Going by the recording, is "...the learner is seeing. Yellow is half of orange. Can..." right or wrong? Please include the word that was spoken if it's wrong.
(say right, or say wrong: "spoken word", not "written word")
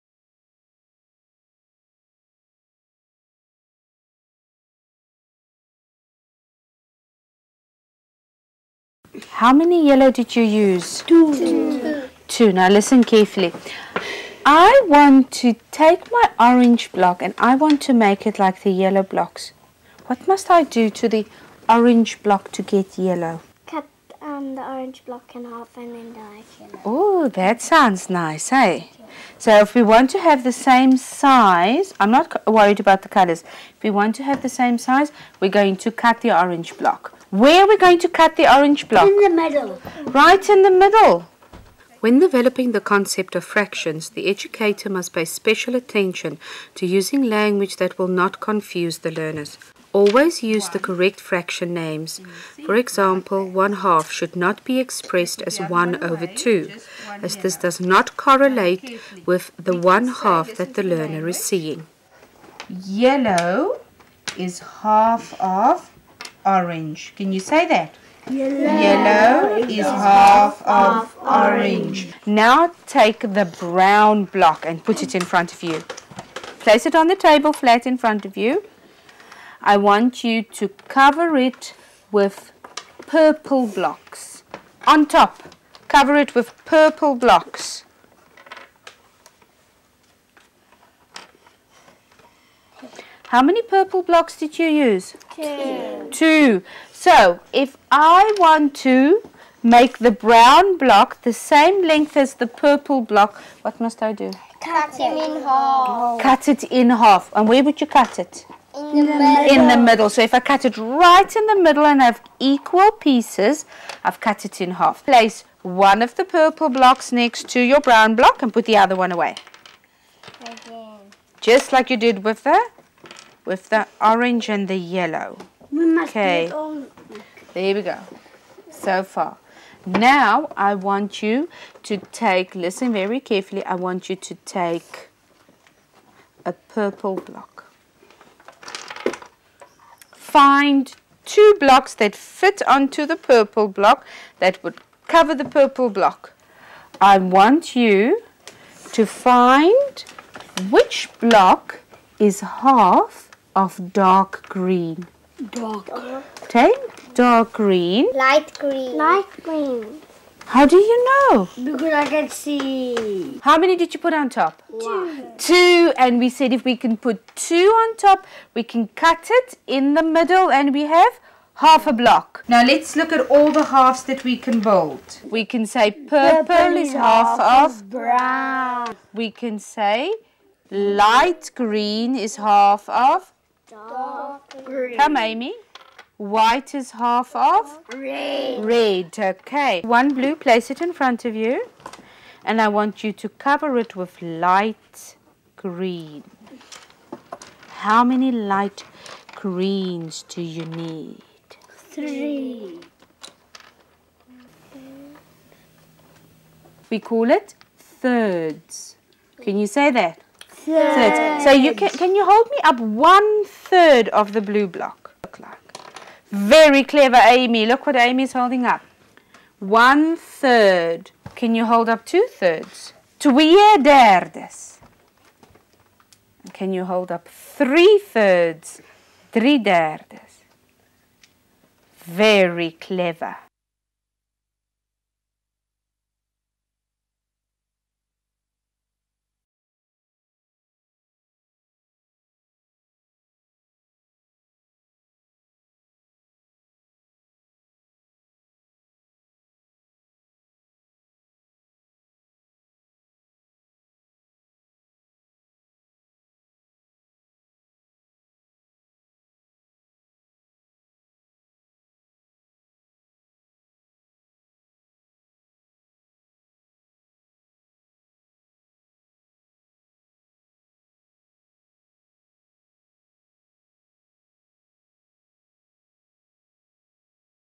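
right.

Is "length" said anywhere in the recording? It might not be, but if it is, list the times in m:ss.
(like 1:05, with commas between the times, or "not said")
1:41.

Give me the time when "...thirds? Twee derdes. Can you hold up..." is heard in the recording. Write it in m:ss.
3:42.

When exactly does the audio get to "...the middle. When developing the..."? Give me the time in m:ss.
0:40.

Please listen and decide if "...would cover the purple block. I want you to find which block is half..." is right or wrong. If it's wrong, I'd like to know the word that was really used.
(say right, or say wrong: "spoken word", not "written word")
right.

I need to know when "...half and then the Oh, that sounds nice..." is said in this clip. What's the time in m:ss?
0:25.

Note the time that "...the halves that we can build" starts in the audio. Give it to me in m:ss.
2:53.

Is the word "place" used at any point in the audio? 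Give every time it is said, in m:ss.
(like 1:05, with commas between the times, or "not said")
1:16, 1:55, 3:10.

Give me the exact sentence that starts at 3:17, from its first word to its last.
How many light greens do you need?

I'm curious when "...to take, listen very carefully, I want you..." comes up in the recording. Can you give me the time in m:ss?
2:11.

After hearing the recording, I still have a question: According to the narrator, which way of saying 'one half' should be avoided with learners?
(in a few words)
1 over 2.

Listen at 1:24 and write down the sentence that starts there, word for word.
On top, cover it with purple blocks.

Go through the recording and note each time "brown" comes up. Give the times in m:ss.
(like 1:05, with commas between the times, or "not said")
1:13, 1:40, 1:57, 2:57.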